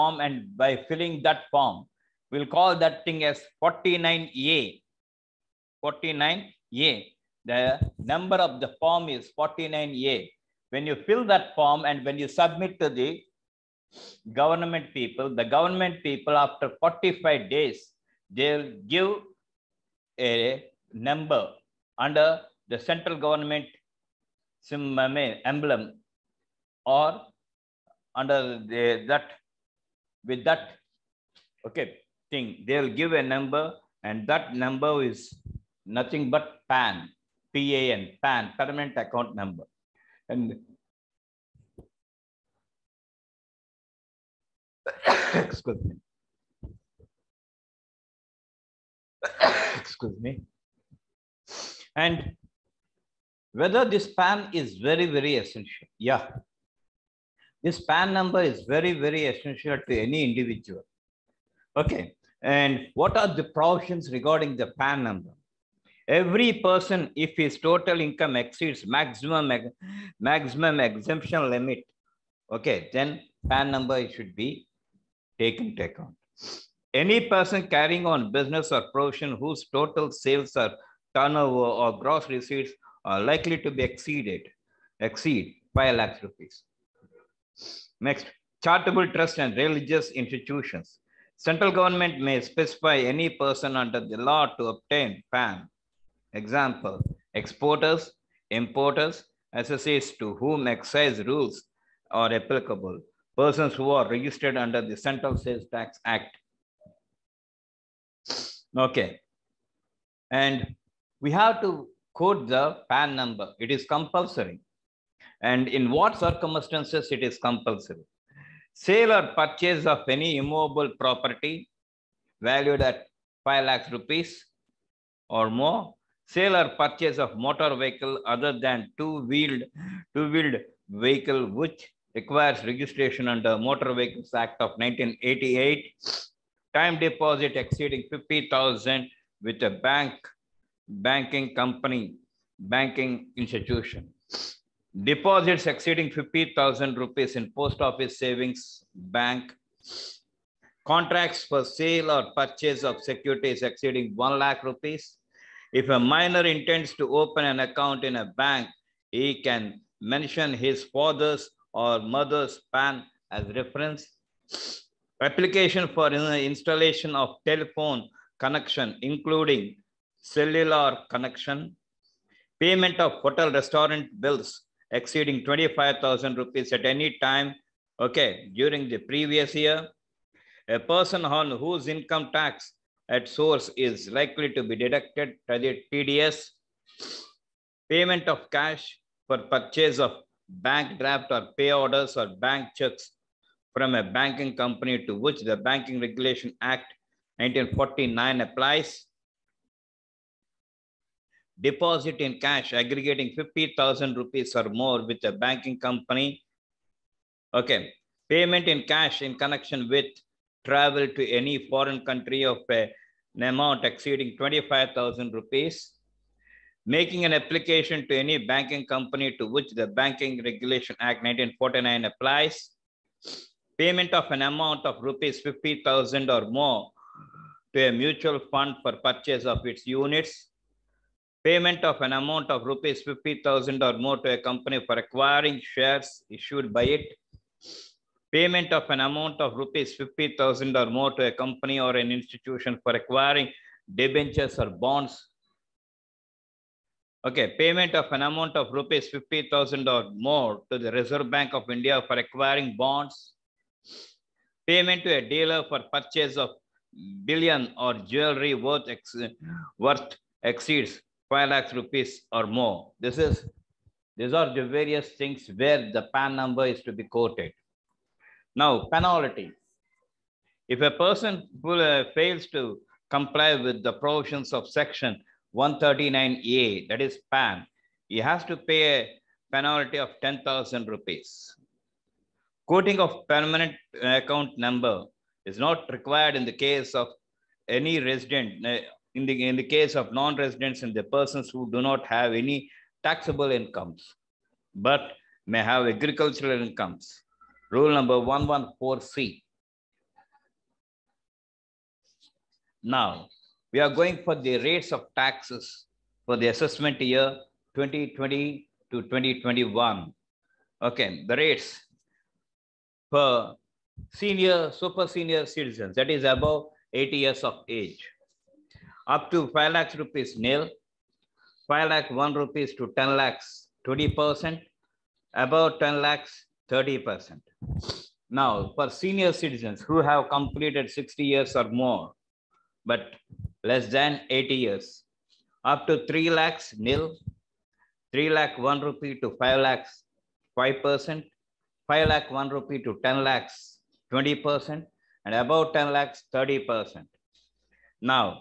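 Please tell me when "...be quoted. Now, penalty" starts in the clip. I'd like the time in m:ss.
4:26.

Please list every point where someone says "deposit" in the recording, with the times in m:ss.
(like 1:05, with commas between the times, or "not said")
2:17, 2:25, 3:21.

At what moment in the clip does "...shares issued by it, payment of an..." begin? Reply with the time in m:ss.
3:55.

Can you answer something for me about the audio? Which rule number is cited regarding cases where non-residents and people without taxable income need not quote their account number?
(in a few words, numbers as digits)
114C.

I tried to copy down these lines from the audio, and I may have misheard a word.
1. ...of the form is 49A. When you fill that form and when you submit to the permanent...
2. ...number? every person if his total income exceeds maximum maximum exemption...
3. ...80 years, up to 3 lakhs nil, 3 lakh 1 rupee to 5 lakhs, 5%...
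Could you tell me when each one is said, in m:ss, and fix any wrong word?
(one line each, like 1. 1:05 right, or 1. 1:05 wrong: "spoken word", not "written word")
1. 0:08 wrong: "government", not "permanent"
2. 1:05 right
3. 5:34 right.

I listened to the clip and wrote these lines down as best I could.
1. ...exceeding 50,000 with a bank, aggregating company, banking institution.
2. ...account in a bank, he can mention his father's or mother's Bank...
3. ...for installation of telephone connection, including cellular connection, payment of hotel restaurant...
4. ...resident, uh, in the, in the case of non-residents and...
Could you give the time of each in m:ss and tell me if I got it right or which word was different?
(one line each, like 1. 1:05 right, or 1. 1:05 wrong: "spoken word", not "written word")
1. 2:17 wrong: "banking", not "aggregating"
2. 2:37 wrong: "PAN", not "Bank"
3. 2:45 right
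4. 4:47 right.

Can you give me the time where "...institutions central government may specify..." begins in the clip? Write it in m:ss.
1:30.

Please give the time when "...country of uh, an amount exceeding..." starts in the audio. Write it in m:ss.
3:32.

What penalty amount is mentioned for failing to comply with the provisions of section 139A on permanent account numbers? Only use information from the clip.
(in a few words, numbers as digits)
10,000 rupees.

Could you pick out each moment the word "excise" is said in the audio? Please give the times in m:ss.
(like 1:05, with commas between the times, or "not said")
1:40.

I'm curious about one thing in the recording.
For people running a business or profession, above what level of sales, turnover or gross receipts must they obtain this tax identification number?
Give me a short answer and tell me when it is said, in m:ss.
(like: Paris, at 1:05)
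5 lakhs rupees, at 1:25.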